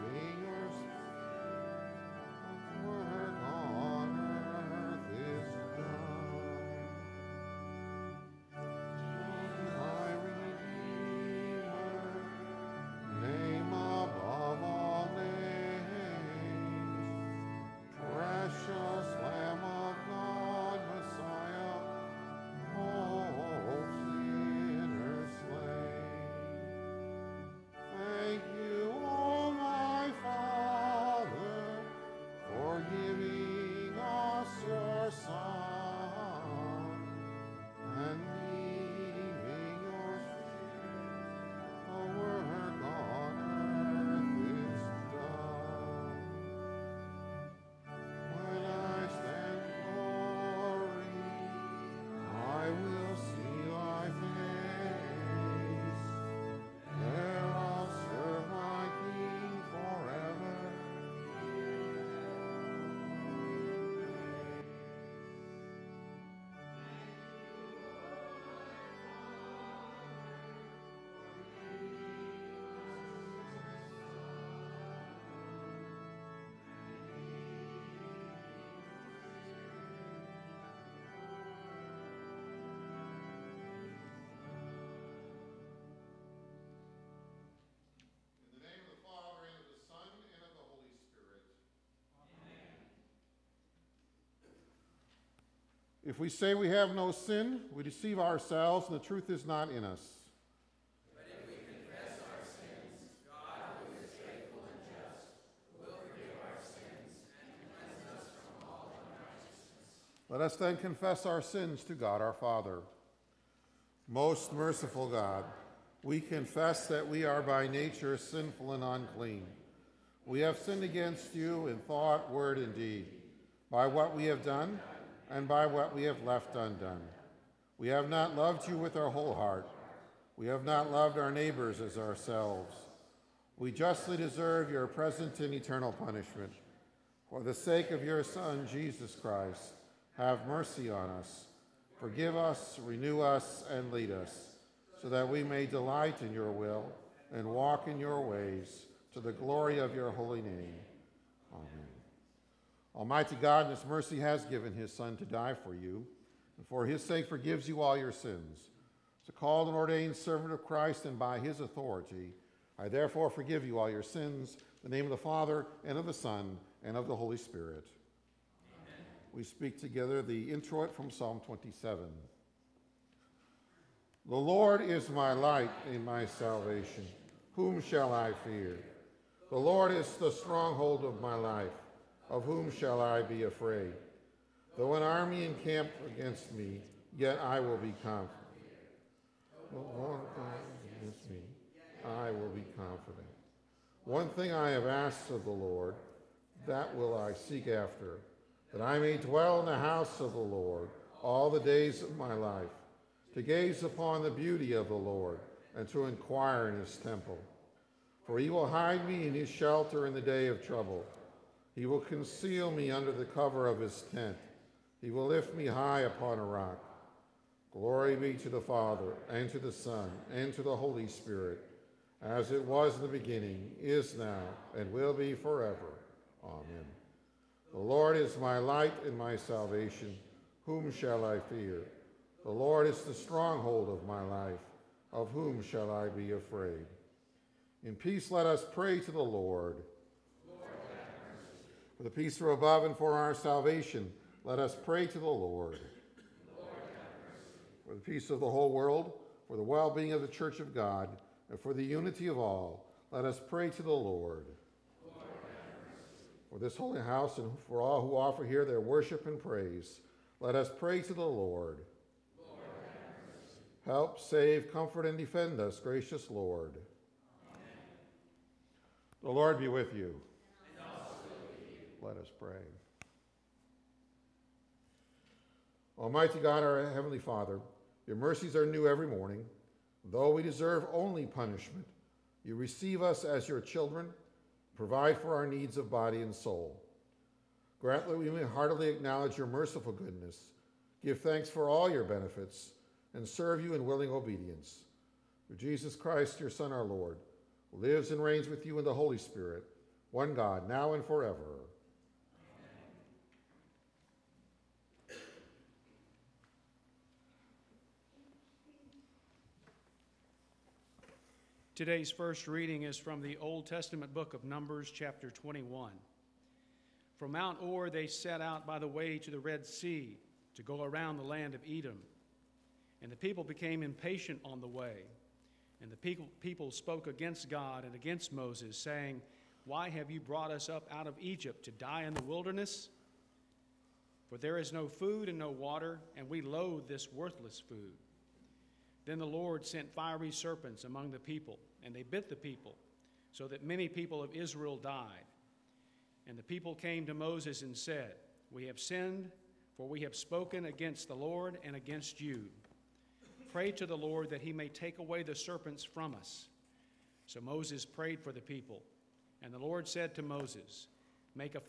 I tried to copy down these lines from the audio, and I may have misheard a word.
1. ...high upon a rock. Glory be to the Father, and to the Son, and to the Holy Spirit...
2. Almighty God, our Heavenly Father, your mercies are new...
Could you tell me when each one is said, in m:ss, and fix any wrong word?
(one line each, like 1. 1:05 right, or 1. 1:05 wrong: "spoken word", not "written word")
1. 3:35 right
2. 4:35 right.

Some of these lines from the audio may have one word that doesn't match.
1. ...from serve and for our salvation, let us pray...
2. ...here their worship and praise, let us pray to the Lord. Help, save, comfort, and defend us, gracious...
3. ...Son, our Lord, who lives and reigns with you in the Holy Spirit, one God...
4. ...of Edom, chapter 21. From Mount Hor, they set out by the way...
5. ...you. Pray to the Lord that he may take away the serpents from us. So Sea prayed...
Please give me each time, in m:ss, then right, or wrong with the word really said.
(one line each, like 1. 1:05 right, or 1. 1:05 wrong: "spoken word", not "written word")
1. 4:02 wrong: "above", not "serve"
2. 4:18 right
3. 4:56 right
4. 5:14 wrong: "Numbers", not "Edom"
5. 5:52 wrong: "Moses", not "Sea".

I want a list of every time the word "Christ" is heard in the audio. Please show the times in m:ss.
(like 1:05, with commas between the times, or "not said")
2:19, 2:40, 4:55.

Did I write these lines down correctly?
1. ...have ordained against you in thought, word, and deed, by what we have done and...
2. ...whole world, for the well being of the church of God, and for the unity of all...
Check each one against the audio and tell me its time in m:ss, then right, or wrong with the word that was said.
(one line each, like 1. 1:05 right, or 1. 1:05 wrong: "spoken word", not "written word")
1. 2:00 wrong: "sinned", not "ordained"
2. 4:08 right.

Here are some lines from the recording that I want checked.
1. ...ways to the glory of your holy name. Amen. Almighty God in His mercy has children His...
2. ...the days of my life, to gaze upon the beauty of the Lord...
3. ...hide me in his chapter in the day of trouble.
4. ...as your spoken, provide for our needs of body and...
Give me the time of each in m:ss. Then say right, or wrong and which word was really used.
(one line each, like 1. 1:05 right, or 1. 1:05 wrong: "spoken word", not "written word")
1. 2:28 wrong: "given", not "children"
2. 3:21 right
3. 3:28 wrong: "shelter", not "chapter"
4. 4:43 wrong: "children", not "spoken".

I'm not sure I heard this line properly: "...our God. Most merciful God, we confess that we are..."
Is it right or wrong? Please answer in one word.
wrong.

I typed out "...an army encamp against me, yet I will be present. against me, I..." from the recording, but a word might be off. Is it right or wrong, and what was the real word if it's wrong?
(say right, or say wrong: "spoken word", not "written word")
wrong: "confident", not "present".